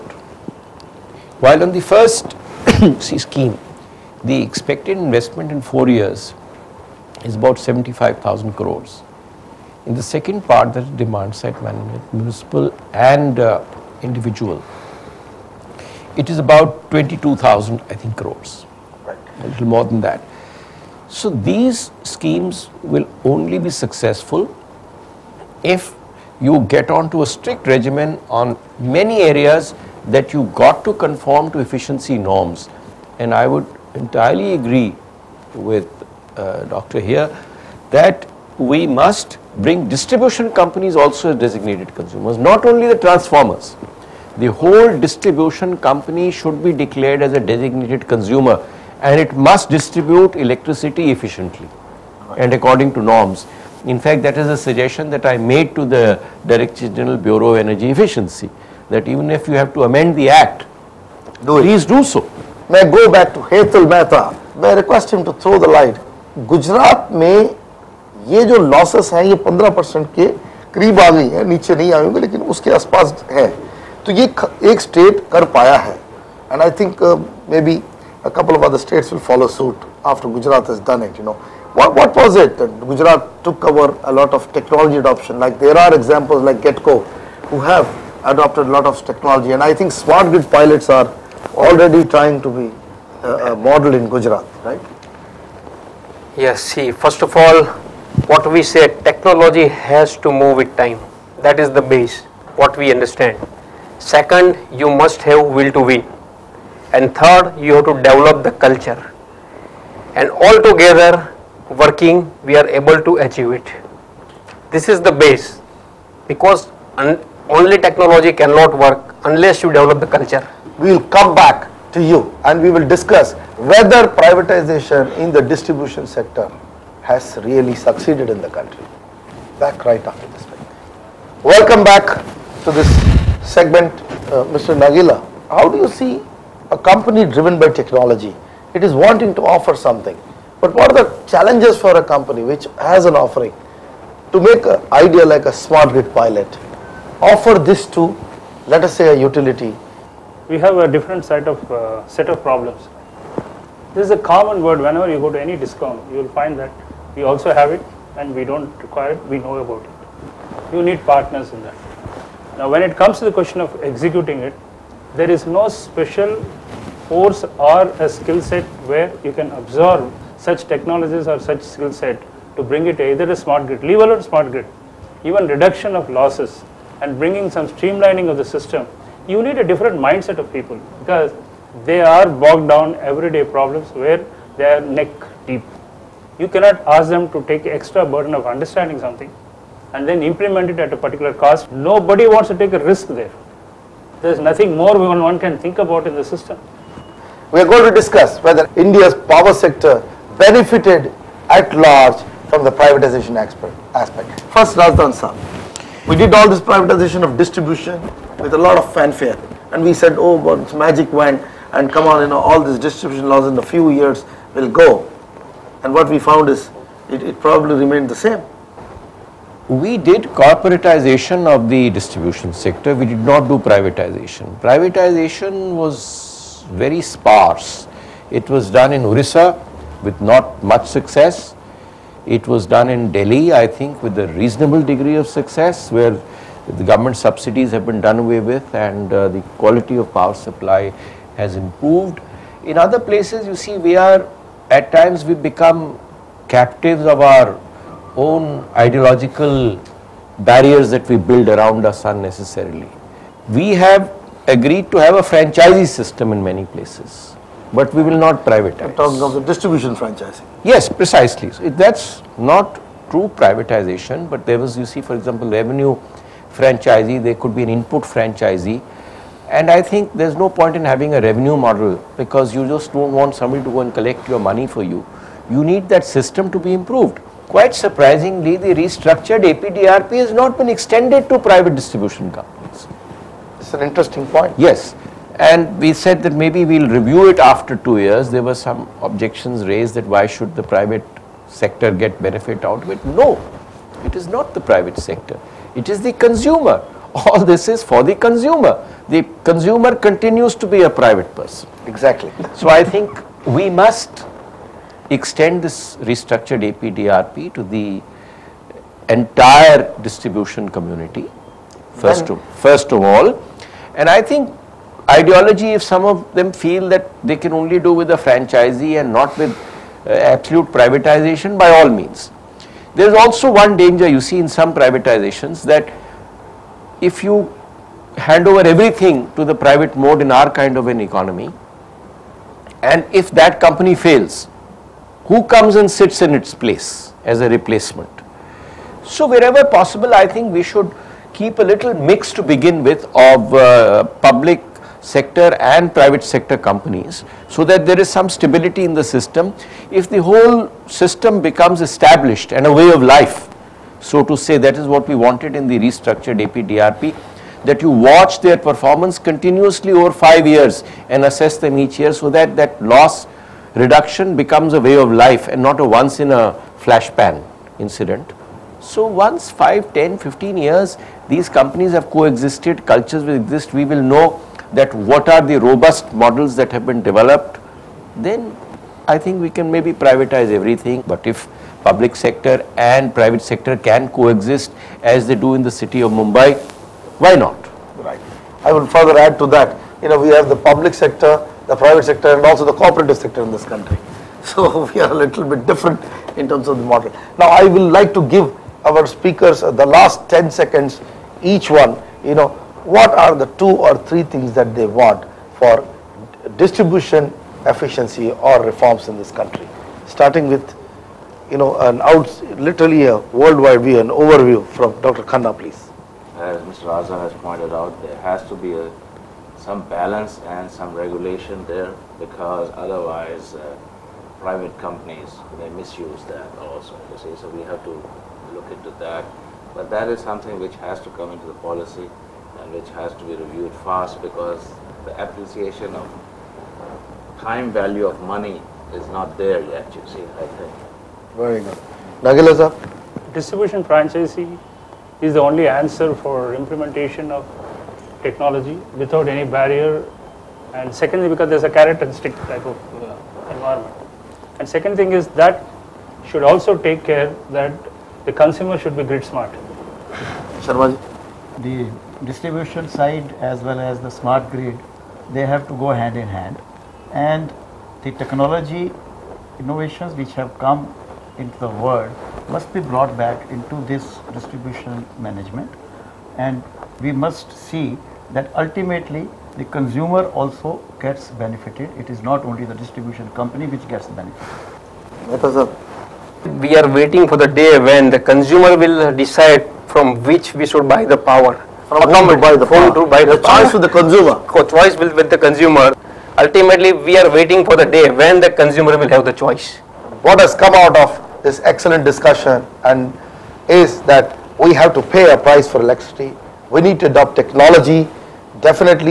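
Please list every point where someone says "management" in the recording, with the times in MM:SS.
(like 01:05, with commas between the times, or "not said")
00:11, 07:55.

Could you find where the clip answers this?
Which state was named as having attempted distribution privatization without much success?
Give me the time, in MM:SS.
03:49.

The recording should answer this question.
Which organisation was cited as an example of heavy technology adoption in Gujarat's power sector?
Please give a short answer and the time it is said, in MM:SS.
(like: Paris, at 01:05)
GetCo, at 01:26.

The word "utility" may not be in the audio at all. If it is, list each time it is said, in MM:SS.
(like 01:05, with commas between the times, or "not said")
02:29.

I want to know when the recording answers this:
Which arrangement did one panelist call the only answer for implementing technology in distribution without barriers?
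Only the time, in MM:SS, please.
07:23.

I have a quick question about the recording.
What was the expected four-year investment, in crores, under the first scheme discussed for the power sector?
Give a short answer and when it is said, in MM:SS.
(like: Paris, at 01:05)
75,000 crores, at 00:07.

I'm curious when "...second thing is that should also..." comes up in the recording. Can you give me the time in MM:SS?
07:34.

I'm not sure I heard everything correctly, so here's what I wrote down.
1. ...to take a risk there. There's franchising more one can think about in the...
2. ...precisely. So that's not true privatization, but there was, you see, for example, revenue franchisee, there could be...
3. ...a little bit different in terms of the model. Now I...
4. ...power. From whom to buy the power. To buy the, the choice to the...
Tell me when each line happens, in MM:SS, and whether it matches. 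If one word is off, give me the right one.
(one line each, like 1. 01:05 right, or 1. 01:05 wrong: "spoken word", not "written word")
1. 03:12 wrong: "nothing", not "franchising"
2. 04:20 right
3. 06:35 right
4. 08:11 right.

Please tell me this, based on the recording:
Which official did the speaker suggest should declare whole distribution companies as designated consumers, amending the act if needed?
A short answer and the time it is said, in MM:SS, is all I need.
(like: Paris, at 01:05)
Director General Bureau of Energy Efficiency, at 00:56.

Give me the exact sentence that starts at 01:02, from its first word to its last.
May I go back to Hetal Mehta?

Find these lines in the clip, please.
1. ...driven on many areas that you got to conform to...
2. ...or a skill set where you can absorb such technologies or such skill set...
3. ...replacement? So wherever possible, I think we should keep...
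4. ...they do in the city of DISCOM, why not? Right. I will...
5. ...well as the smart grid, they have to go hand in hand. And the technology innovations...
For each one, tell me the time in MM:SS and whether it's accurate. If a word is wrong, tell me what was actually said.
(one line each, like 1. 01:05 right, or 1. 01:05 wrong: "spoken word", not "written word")
1. 00:27 wrong: "regimen", not "driven"
2. 02:47 right
3. 05:37 right
4. 06:25 wrong: "Mumbai", not "DISCOM"
5. 07:43 right.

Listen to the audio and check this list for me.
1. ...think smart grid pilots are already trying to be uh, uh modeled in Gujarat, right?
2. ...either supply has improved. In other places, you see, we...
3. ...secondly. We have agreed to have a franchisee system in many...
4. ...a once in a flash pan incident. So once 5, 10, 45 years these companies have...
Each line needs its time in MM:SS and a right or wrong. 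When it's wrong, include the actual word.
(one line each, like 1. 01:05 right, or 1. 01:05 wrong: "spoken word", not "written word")
1. 01:29 right
2. 04:00 wrong: "power", not "either"
3. 04:12 wrong: "unnecessarily", not "secondly"
4. 06:05 wrong: "15", not "45".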